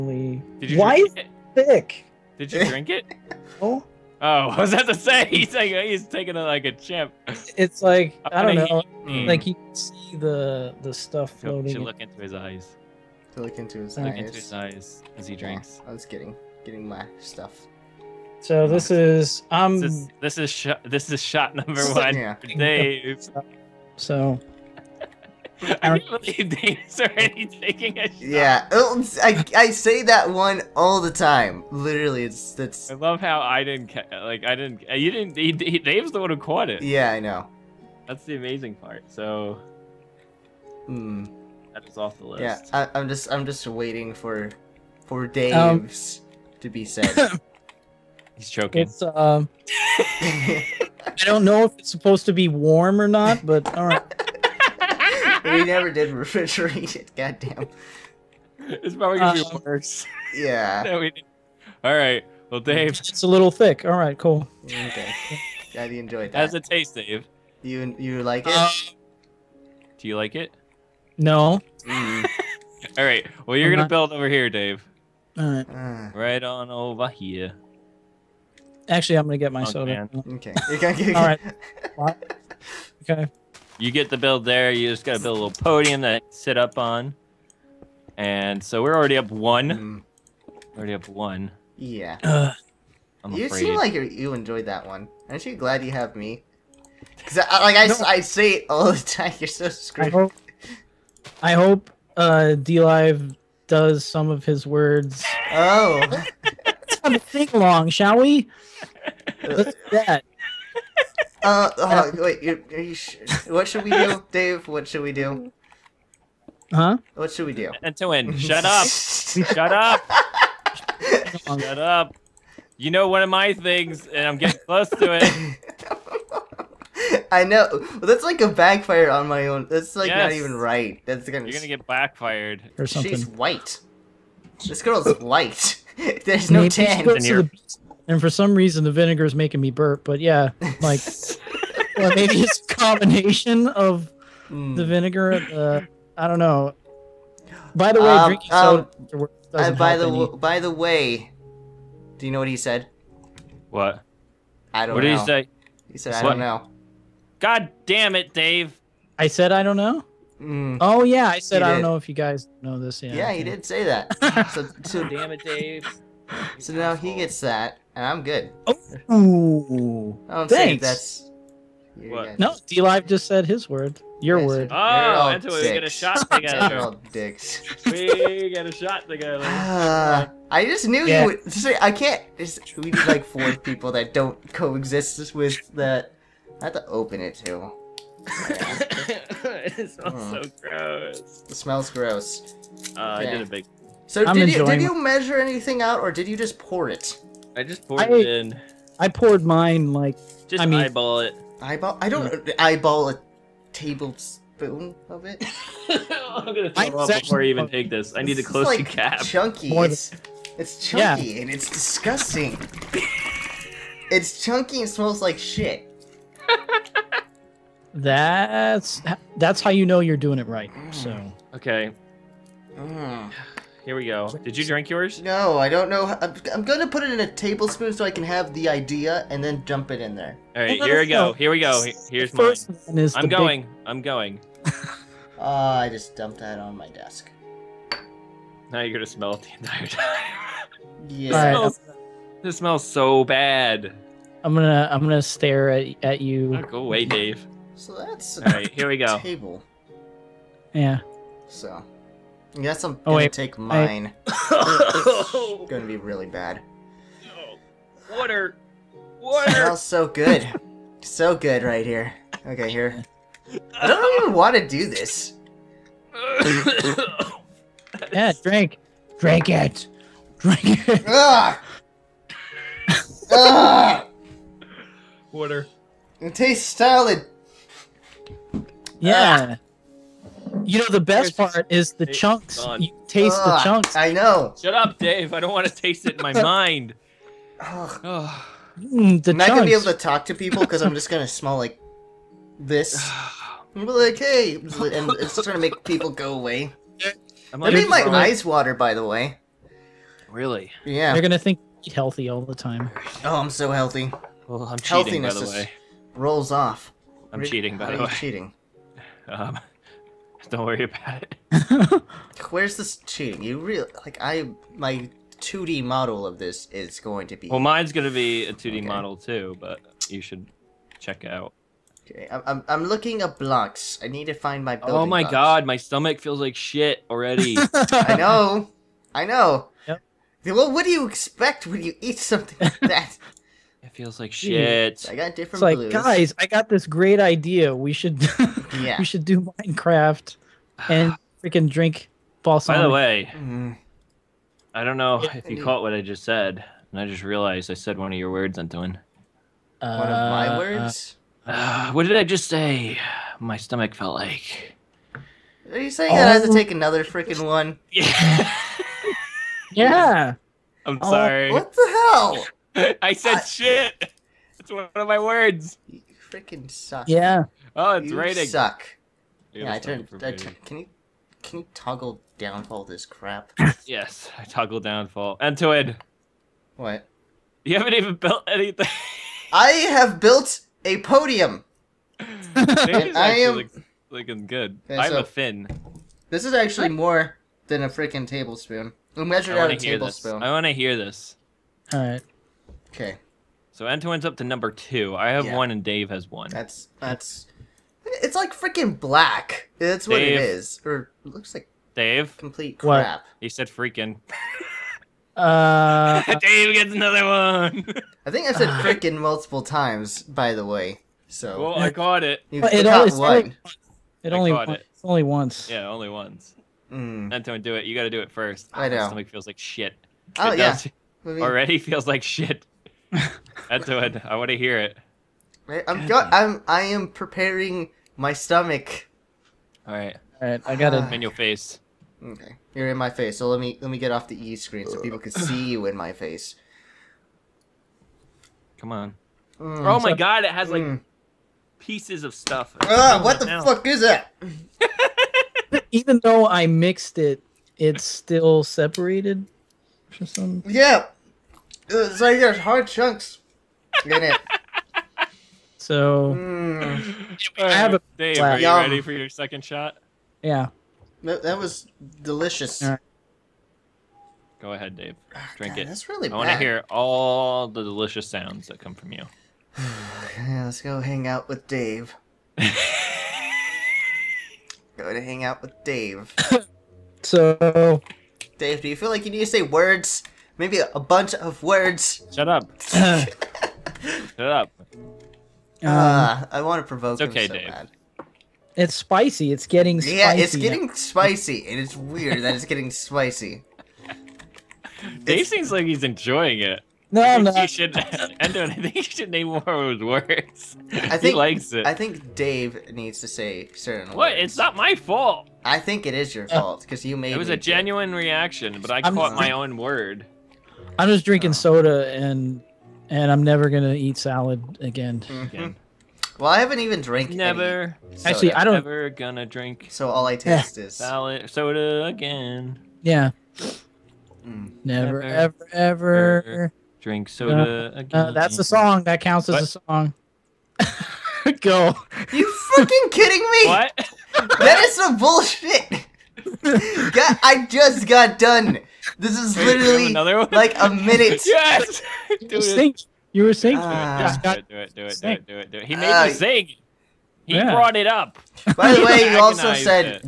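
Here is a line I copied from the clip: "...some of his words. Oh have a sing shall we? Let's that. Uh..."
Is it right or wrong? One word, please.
right.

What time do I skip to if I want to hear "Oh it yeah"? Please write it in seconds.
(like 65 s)
420 s.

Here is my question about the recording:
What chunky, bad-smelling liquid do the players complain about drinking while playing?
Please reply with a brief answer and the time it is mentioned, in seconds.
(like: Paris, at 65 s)
balsamic, at 342 s.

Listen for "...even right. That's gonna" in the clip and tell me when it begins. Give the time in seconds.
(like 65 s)
130 s.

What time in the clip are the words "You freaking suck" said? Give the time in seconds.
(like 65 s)
365 s.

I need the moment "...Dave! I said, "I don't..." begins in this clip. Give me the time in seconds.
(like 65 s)
158 s.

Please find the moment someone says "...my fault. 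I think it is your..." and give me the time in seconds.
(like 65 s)
504 s.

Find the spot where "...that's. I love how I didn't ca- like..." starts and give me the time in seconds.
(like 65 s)
32 s.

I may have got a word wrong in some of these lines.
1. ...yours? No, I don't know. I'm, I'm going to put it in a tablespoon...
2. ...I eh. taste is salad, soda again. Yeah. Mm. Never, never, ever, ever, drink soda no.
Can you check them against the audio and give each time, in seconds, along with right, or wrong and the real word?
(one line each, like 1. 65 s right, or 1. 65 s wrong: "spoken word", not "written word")
1. 224 s right
2. 520 s right.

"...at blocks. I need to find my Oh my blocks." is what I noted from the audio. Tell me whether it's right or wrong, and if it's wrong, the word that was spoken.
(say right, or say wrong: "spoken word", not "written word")
right.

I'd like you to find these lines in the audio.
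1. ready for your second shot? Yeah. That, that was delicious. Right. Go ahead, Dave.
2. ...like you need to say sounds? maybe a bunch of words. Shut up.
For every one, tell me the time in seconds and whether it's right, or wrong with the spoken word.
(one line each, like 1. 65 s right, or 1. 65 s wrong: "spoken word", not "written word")
1. 458 s right
2. 479 s wrong: "words", not "sounds".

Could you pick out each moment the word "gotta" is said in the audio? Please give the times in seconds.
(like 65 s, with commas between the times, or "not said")
85 s.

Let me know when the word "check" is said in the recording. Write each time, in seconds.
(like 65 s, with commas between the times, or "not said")
320 s.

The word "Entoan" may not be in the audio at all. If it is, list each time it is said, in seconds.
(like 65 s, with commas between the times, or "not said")
117 s, 348 s, 393 s, 417 s.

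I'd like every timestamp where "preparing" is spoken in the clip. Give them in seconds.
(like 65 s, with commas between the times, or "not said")
427 s.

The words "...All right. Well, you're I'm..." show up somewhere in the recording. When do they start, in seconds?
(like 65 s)
72 s.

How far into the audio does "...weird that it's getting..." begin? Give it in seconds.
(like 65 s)
491 s.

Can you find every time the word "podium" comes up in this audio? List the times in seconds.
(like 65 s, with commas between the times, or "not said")
85 s, 381 s.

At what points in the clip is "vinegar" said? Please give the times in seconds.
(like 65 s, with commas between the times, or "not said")
138 s, 144 s.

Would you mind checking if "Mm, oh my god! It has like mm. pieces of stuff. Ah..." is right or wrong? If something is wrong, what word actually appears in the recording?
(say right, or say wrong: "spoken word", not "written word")
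right.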